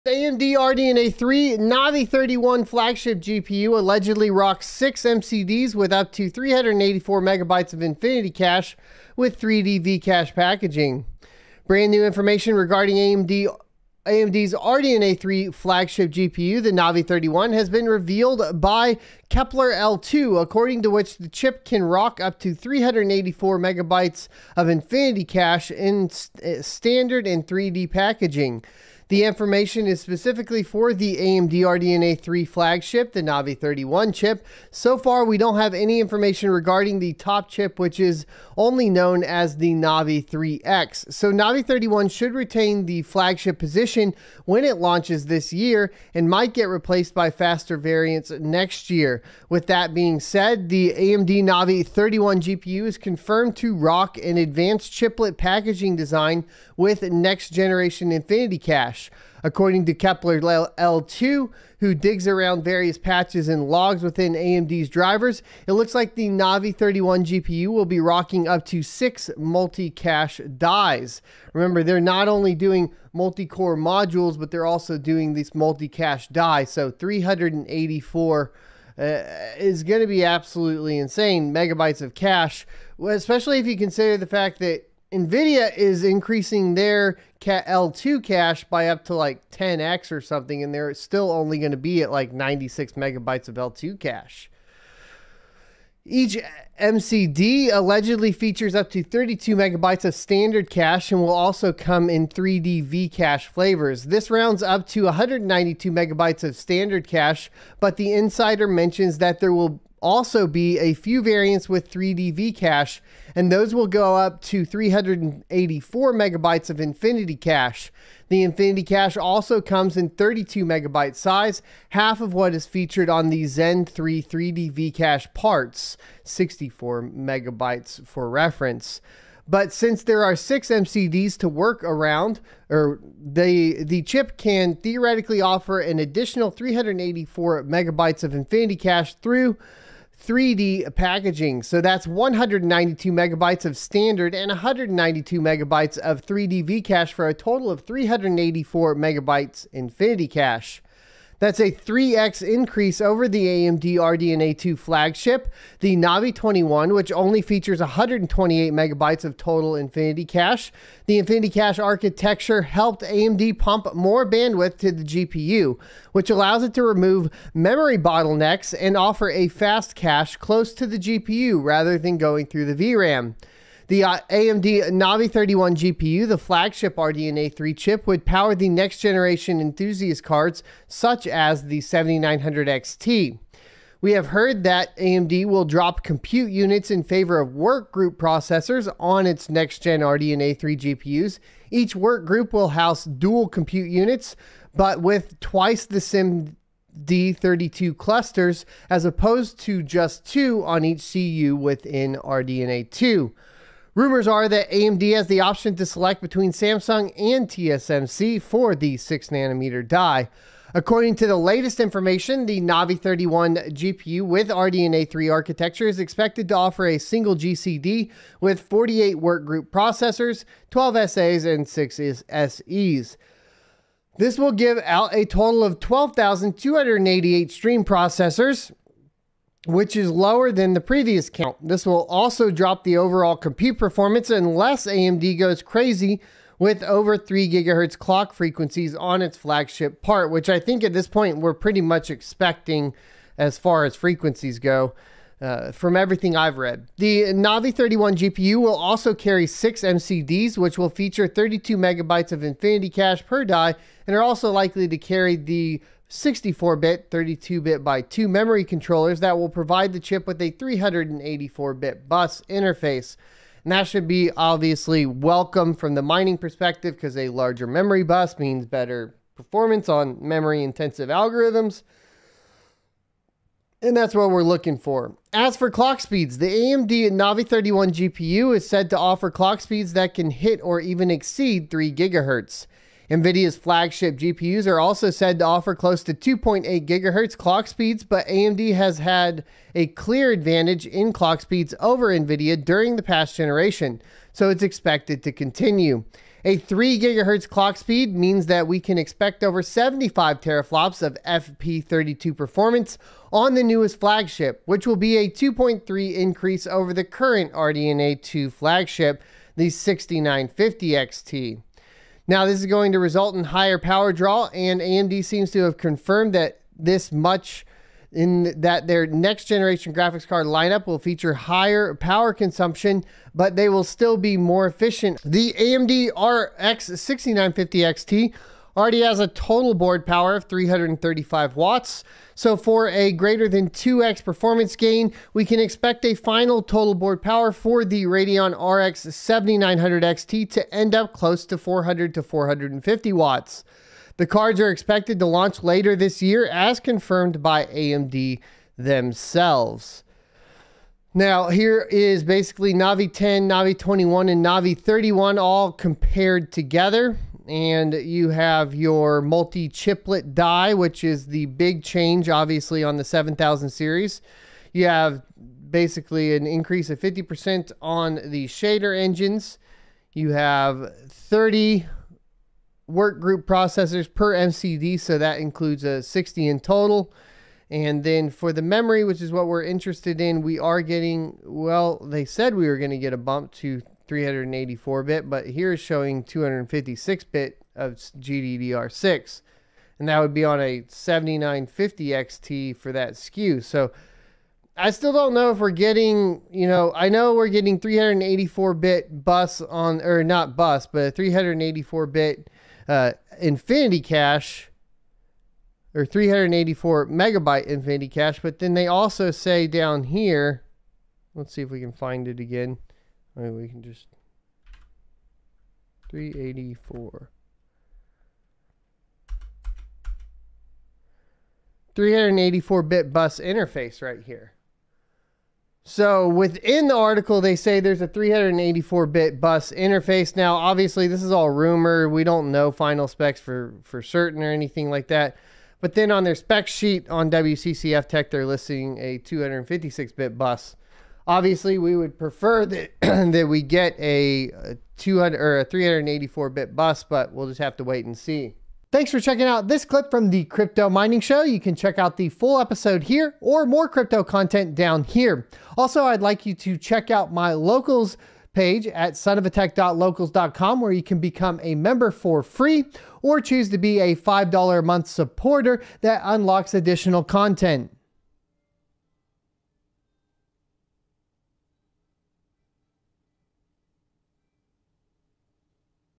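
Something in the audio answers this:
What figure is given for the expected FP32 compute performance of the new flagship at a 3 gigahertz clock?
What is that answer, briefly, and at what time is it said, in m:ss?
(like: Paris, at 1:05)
over 75 teraflops, at 4:59.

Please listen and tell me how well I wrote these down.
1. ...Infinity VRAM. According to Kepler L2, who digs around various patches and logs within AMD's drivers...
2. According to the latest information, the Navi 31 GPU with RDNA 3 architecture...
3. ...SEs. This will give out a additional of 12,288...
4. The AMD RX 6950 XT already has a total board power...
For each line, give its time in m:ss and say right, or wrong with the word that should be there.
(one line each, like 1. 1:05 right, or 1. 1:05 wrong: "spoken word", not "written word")
1. 0:58 wrong: "Cache", not "VRAM"
2. 3:30 right
3. 3:42 wrong: "total", not "additional"
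4. 5:25 right.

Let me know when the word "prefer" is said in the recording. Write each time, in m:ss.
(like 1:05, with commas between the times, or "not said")
7:22.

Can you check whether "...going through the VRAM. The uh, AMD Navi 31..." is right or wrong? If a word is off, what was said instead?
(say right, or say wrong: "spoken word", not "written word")
right.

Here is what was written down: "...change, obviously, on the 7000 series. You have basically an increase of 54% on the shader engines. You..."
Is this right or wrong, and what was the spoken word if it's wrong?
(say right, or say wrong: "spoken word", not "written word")
wrong: "50", not "54".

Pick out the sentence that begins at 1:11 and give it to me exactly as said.
Remember, they're not only doing multi core modules, but they're also doing these multi cache die.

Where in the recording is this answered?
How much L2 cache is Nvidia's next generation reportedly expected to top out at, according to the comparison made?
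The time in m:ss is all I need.
1:32.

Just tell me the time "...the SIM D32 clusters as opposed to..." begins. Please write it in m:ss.
3:15.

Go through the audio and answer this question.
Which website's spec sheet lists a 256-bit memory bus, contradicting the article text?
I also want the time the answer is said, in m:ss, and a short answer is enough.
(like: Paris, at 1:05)
WCCF Tech, at 7:17.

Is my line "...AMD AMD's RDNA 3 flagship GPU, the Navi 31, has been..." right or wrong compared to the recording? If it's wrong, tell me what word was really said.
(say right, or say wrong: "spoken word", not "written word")
right.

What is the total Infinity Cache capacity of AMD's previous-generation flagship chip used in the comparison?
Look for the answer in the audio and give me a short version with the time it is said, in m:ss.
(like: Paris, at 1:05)
128 megabytes, at 2:37.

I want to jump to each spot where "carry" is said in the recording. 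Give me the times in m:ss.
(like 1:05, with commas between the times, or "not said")
4:09, 4:14.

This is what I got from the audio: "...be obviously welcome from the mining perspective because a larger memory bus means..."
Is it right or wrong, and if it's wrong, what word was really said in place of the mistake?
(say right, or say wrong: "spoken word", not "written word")
right.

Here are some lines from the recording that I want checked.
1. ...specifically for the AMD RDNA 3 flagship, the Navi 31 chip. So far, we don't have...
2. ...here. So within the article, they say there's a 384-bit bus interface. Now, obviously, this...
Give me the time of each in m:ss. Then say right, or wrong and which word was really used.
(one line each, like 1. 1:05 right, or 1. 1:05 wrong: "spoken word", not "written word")
1. 0:29 right
2. 7:04 right.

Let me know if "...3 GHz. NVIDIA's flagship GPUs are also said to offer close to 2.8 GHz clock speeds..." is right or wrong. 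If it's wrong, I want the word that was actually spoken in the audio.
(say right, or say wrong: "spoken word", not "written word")
right.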